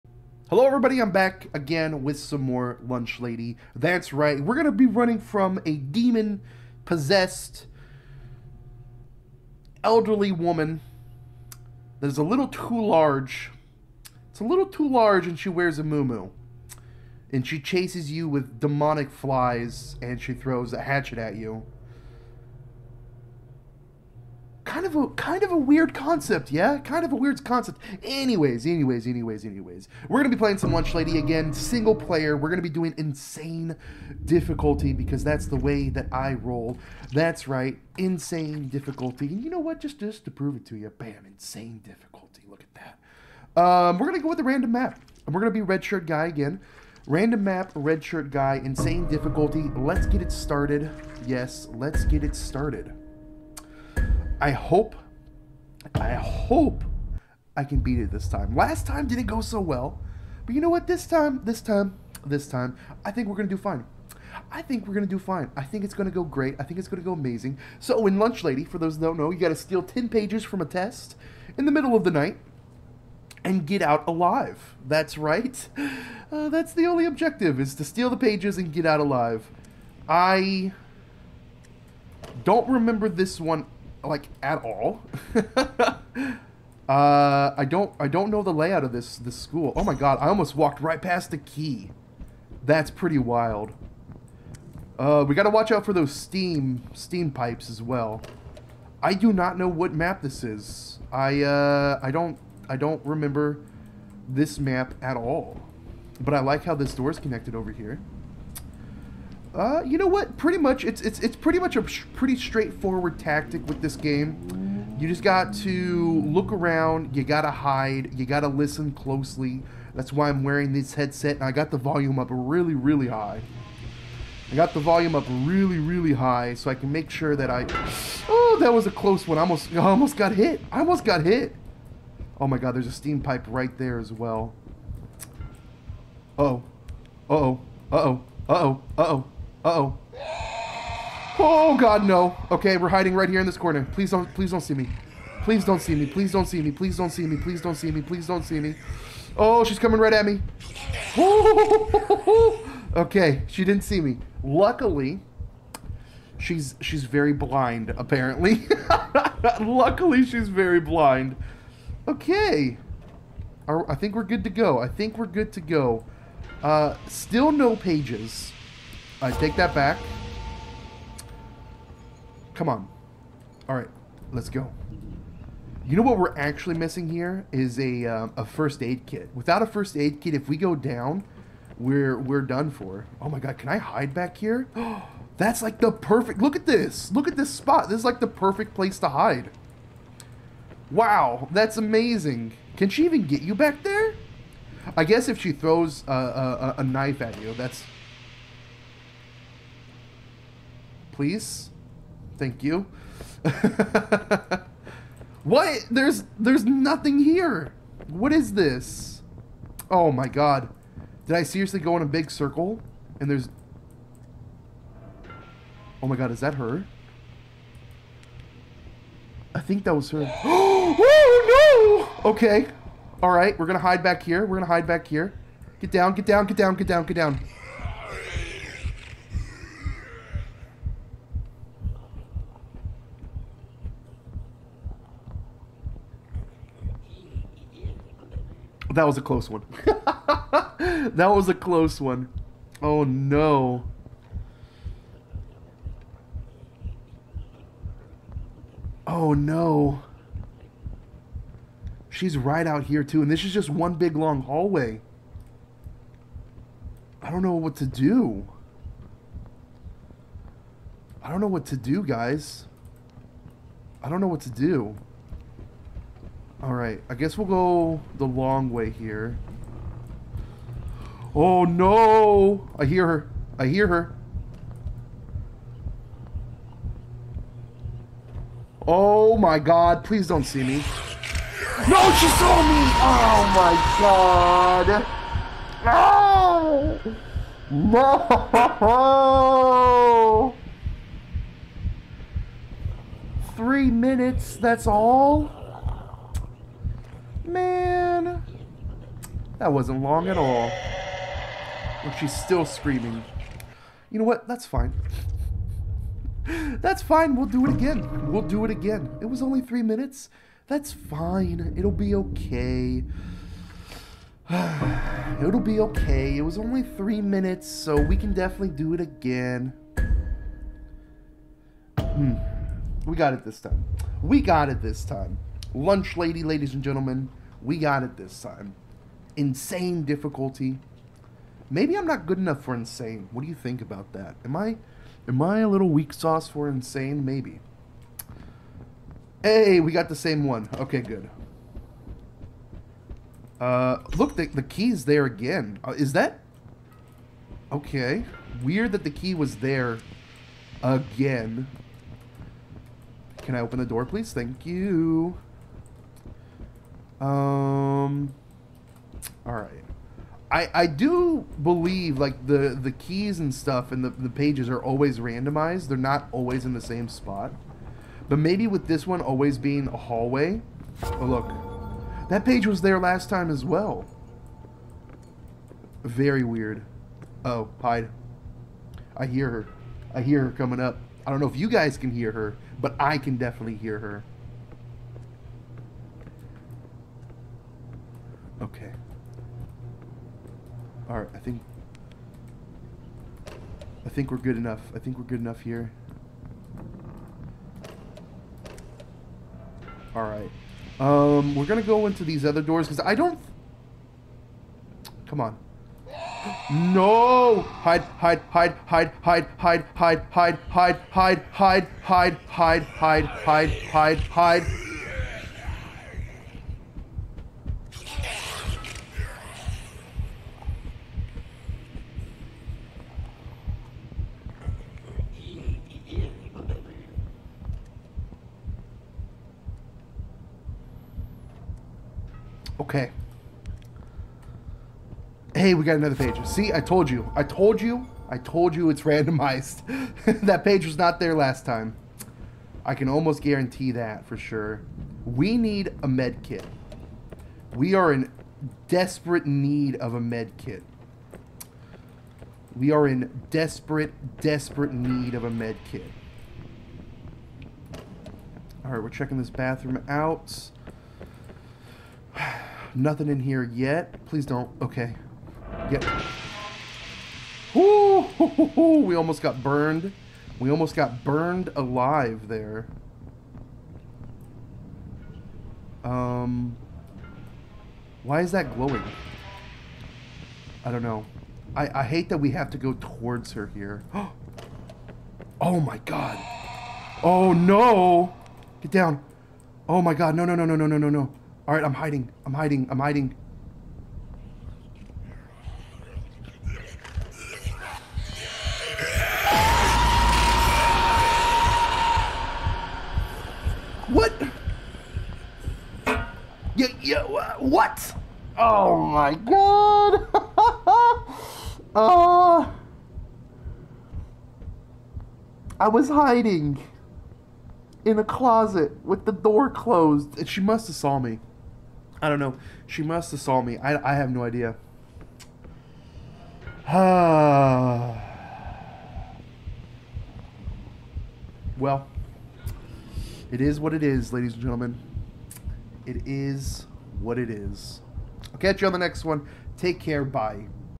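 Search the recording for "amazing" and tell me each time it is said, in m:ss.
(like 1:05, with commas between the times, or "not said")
1:07, 3:11.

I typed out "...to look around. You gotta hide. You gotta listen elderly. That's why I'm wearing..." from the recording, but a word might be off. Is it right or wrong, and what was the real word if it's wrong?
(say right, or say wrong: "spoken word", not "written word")
wrong: "closely", not "elderly".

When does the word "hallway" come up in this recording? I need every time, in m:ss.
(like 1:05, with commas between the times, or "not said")
4:14, 6:09.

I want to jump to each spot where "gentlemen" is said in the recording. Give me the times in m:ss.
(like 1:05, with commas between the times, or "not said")
5:26, 8:54.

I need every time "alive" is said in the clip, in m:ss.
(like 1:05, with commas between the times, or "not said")
1:14, 1:19, 7:51.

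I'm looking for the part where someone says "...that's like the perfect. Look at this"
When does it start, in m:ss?
3:05.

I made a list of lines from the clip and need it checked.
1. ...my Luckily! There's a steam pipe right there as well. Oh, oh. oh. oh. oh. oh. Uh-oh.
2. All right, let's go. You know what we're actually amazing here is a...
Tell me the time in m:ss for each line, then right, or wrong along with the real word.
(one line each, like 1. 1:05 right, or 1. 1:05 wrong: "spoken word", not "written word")
1. 2:12 wrong: "God", not "Luckily"
2. 2:53 wrong: "missing", not "amazing".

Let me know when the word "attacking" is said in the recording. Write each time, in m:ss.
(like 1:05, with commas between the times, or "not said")
not said.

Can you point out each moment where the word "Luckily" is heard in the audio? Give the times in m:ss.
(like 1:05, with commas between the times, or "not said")
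2:34, 2:39.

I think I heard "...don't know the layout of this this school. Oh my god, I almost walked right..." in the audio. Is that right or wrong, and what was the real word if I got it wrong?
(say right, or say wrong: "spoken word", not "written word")
right.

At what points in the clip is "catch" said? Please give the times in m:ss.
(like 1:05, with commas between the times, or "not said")
8:58.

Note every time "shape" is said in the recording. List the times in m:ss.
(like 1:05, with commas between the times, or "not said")
not said.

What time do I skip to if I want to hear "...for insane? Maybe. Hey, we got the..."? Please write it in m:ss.
5:36.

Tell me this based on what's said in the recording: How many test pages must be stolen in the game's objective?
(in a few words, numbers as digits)
10.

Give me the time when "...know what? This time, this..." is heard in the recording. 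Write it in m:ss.
1:00.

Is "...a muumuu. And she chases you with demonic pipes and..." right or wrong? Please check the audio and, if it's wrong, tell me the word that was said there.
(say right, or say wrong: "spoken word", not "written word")
wrong: "flies", not "pipes".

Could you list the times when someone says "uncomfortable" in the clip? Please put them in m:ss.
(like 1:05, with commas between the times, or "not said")
not said.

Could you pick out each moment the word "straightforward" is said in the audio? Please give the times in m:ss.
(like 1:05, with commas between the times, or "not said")
1:52.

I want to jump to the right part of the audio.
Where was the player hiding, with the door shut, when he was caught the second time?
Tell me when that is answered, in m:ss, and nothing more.
8:38.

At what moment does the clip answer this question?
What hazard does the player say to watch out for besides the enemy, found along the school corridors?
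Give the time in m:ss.
1:36.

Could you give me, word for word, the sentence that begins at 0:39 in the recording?
Just just to prove it to you, bam, insane difficulty.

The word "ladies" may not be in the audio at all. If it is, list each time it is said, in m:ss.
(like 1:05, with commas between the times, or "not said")
5:26, 8:54.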